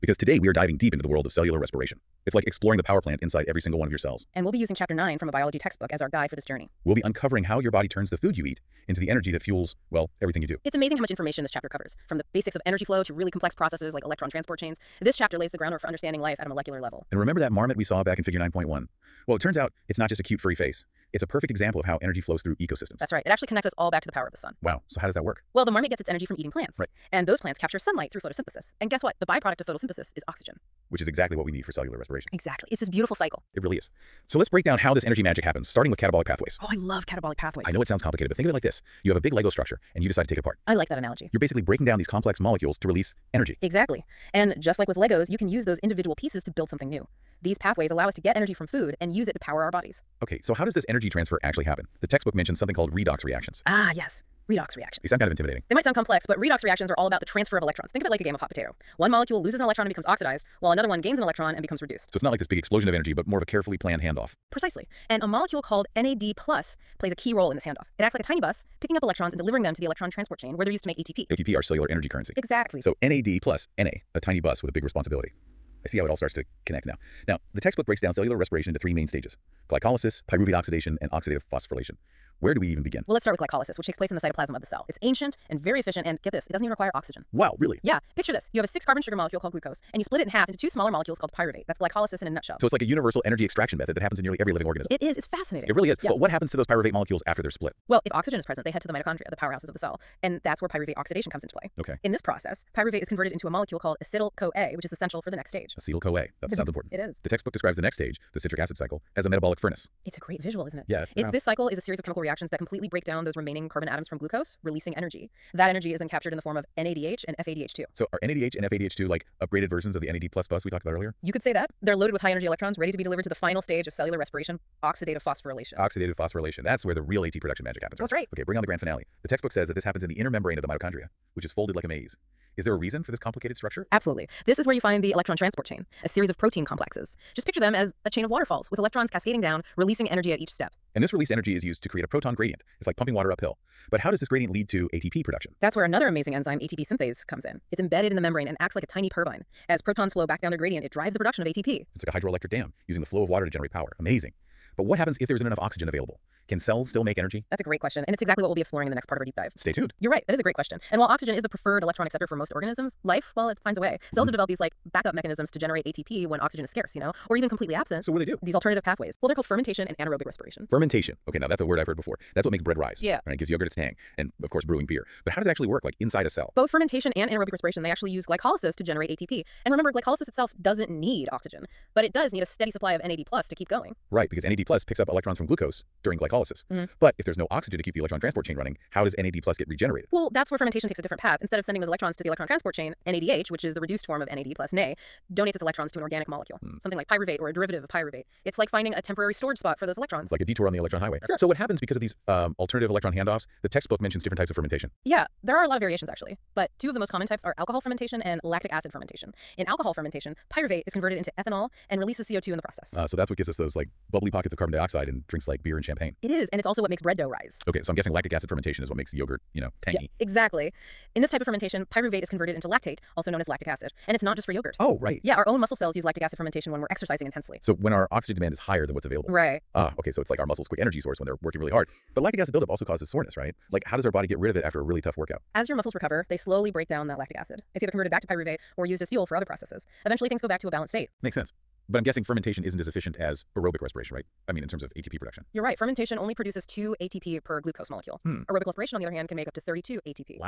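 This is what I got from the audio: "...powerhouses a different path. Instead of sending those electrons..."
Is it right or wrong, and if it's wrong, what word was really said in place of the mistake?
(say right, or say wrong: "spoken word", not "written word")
wrong: "takes", not "powerhouses".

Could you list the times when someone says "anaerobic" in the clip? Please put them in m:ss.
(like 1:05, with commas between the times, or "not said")
2:49, 2:57.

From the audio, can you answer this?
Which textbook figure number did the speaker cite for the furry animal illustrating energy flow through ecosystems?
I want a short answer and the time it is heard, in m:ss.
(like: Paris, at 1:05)
Figure 9.1, at 0:18.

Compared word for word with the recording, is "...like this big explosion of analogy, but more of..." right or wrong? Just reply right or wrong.
wrong.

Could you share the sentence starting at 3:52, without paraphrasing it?
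But lactic acid buildup also causes soreness, right?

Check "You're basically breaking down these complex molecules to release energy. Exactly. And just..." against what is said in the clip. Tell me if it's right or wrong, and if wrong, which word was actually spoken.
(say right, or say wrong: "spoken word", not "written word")
right.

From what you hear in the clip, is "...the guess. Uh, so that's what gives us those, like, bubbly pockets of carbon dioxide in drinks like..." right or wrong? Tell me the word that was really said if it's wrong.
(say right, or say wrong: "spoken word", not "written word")
wrong: "process", not "guess".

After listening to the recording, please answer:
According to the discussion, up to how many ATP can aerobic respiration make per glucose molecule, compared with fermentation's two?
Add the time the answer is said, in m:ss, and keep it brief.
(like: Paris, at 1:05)
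32, at 4:09.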